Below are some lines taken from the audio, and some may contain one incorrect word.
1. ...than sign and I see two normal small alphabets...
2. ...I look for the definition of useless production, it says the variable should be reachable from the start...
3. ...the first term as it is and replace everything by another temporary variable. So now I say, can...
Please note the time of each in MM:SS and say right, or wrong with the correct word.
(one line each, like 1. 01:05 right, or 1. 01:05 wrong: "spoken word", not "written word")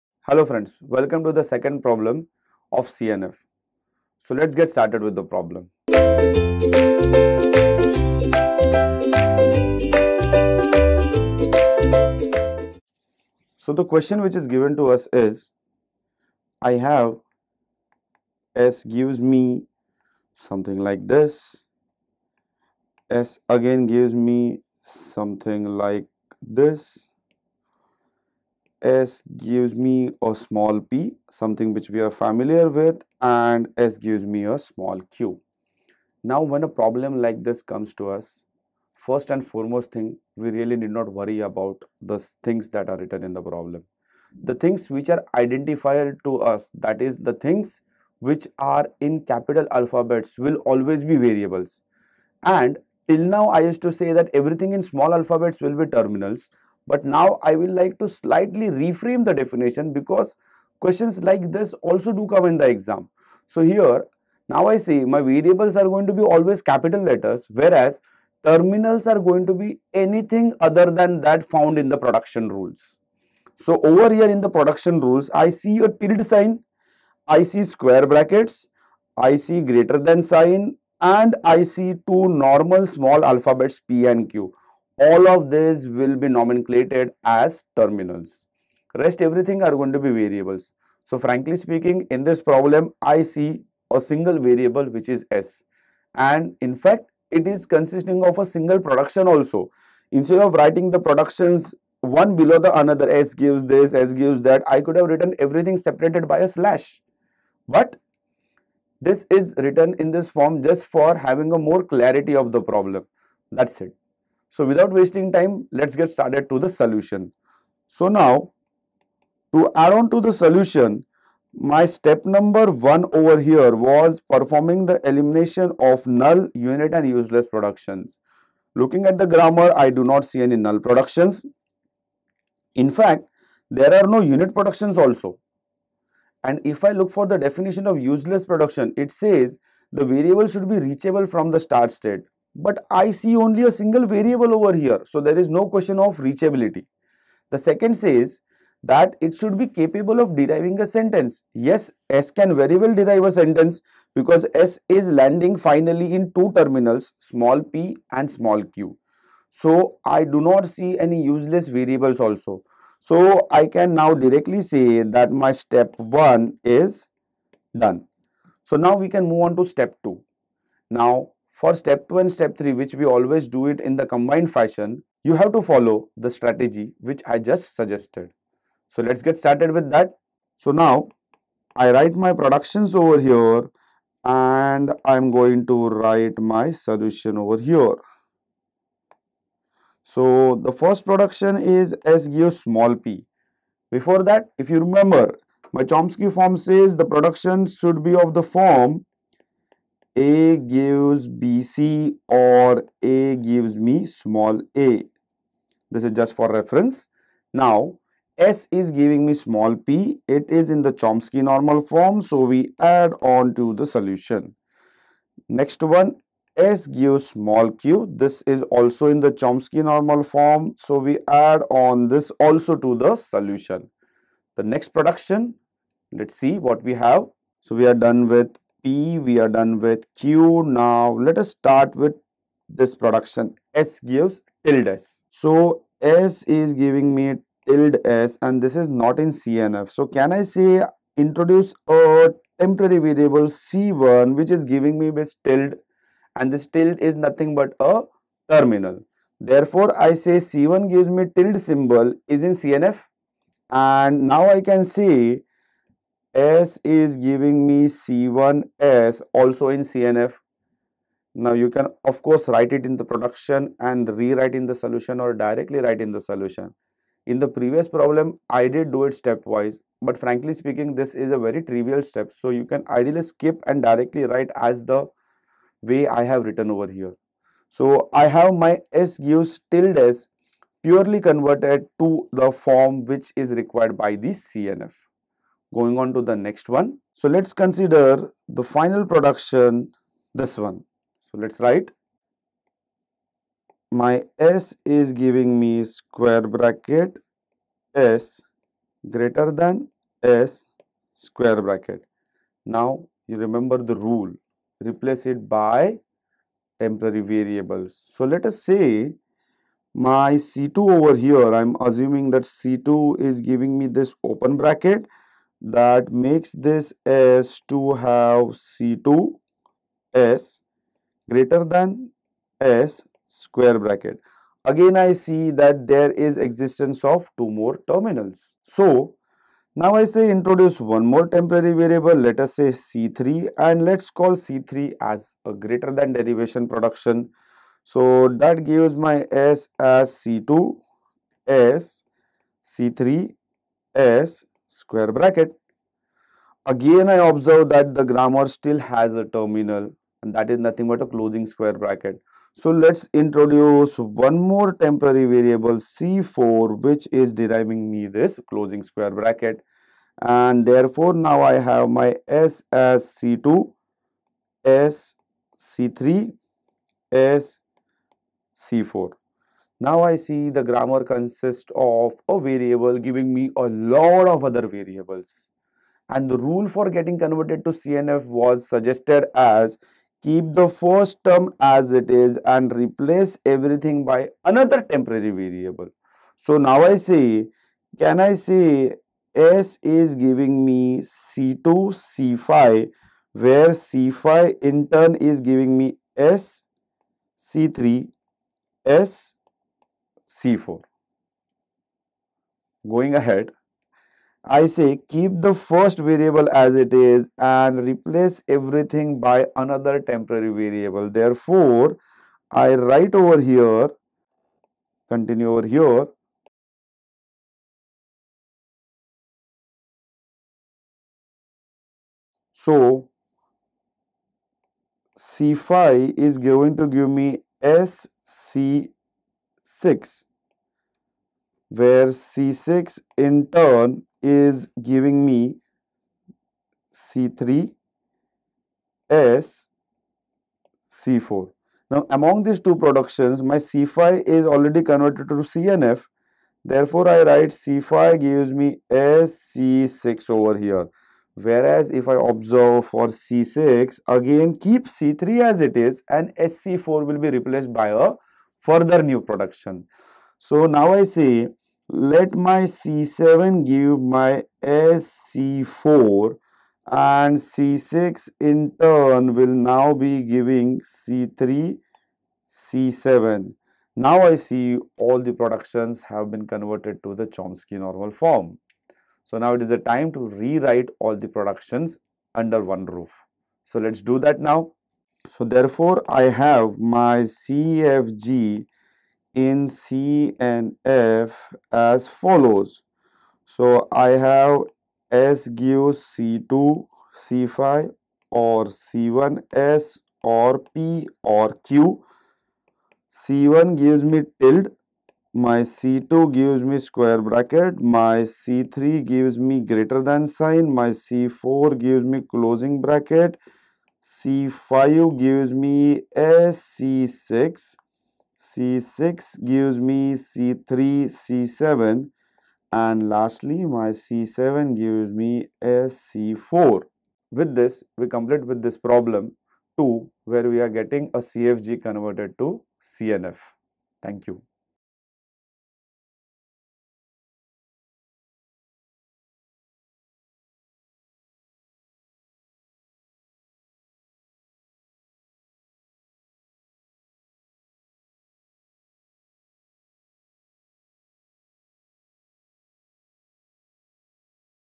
1. 01:19 right
2. 02:16 right
3. 06:20 right.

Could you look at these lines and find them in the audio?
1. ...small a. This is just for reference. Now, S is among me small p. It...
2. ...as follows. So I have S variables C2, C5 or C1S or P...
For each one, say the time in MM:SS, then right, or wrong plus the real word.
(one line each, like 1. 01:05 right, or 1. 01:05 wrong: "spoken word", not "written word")
1. 03:24 wrong: "giving", not "among"
2. 08:11 wrong: "gives", not "variables".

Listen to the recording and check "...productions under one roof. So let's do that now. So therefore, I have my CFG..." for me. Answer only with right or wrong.
right.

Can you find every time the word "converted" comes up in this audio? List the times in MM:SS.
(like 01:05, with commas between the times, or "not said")
04:41, 06:17, 07:24, 07:56, 08:51.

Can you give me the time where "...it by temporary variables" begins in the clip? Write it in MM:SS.
05:05.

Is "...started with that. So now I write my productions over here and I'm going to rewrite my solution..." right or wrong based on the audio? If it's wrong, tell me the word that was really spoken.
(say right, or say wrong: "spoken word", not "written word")
wrong: "write", not "rewrite".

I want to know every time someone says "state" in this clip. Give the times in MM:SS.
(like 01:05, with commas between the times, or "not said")
02:21.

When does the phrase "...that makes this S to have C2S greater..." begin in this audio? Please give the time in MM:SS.
05:15.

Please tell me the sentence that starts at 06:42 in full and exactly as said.
Going ahead, I say keep the first variable as it is and replace everything by another temporary variable.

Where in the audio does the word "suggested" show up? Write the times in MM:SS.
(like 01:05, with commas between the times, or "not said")
02:57, 06:18.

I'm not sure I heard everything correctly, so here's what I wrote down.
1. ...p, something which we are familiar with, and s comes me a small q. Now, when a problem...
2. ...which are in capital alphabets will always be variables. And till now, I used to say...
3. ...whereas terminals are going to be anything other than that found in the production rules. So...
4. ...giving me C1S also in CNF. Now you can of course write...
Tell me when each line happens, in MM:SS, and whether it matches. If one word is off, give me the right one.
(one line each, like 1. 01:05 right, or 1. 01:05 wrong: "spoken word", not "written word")
1. 00:30 wrong: "gives", not "comes"
2. 00:48 right
3. 01:07 right
4. 04:17 right.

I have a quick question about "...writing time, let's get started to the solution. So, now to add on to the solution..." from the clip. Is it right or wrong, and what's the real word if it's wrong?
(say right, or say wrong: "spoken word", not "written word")
wrong: "wasting", not "writing".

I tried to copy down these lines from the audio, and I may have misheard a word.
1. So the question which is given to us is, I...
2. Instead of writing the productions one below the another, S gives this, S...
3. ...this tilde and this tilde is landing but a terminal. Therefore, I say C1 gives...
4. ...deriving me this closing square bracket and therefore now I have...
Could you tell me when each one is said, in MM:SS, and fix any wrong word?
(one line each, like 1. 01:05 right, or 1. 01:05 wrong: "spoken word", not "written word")
1. 00:13 right
2. 01:40 right
3. 04:05 wrong: "nothing", not "landing"
4. 05:57 right.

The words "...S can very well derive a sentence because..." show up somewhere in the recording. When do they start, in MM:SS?
02:32.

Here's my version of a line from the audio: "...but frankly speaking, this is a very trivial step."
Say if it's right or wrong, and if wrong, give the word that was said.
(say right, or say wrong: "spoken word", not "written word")
right.